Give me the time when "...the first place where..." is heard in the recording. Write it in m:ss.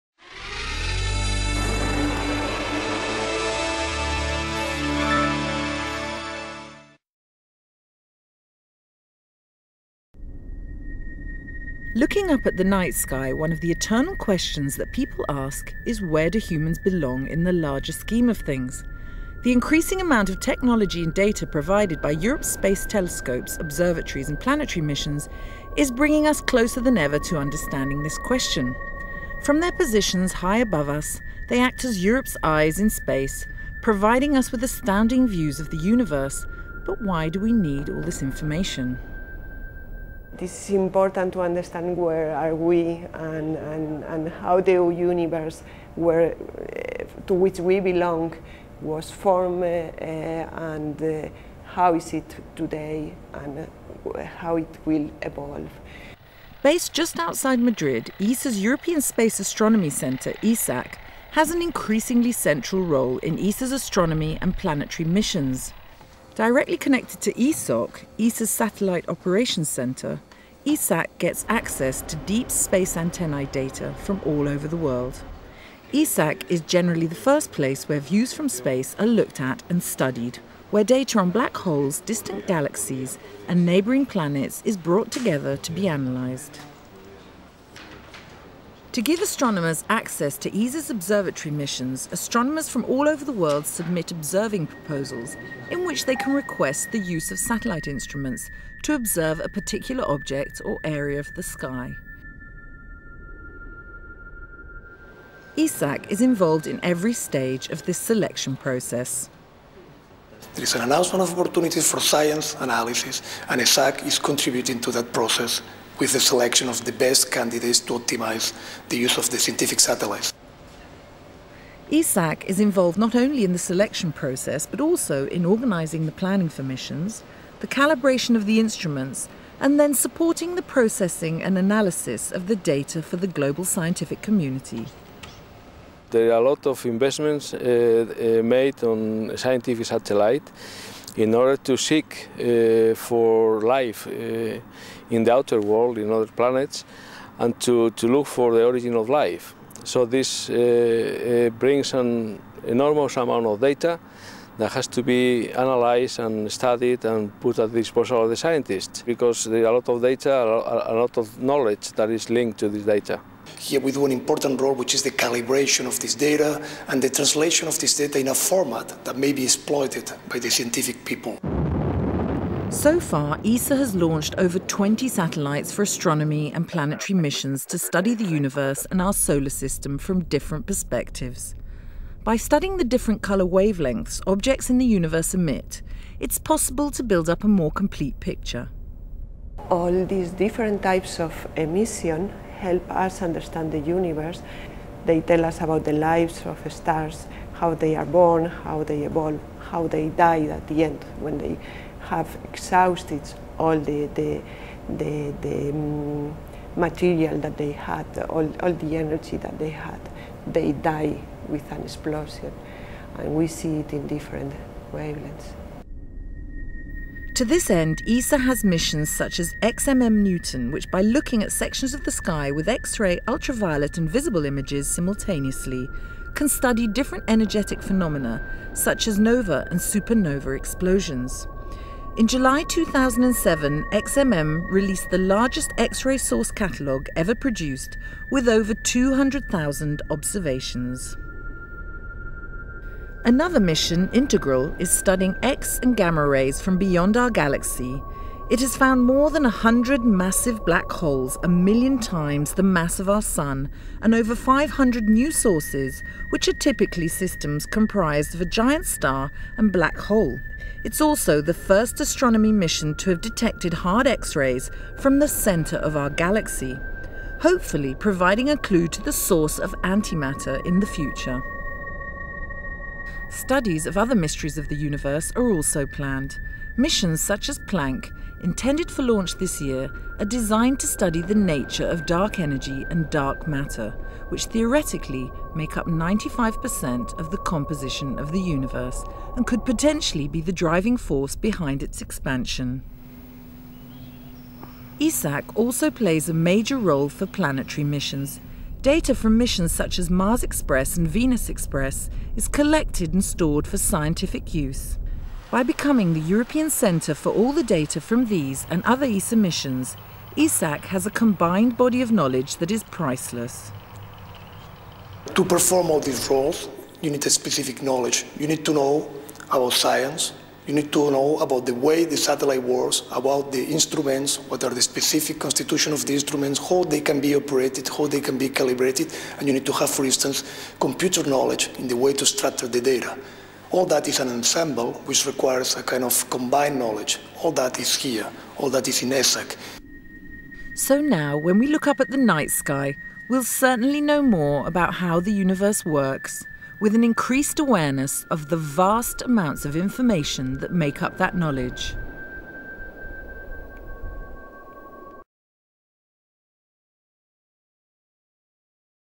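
1:17.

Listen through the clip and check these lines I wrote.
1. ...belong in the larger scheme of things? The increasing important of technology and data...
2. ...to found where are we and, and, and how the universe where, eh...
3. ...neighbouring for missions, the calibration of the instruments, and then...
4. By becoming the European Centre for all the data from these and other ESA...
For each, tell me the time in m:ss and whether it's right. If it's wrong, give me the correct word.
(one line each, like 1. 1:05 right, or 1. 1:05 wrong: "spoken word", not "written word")
1. 0:16 wrong: "amount", not "important"
2. 0:41 wrong: "understand", not "found"
3. 2:06 wrong: "planning", not "neighbouring"
4. 5:05 right.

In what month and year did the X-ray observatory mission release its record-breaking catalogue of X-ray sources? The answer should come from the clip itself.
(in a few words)
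July 2007.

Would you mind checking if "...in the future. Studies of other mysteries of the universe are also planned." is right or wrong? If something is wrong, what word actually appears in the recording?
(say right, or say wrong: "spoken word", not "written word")
right.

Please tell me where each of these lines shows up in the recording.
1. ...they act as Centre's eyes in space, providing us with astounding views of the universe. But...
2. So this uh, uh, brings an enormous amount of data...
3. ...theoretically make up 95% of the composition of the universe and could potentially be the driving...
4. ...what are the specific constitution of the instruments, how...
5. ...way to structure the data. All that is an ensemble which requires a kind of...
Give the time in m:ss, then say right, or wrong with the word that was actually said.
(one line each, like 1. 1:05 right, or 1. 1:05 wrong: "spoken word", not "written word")
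1. 0:31 wrong: "Europe", not "Centre"
2. 2:29 right
3. 4:44 right
4. 5:24 right
5. 5:31 right.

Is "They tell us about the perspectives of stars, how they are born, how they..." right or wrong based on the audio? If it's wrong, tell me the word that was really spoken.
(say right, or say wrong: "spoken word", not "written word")
wrong: "lives", not "perspectives".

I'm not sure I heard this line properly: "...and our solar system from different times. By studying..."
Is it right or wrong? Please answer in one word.
wrong.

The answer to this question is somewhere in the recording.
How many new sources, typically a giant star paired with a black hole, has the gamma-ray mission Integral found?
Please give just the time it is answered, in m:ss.
4:14.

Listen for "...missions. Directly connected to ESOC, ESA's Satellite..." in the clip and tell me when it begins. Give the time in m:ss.
1:05.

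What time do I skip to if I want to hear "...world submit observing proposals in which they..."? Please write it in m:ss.
1:33.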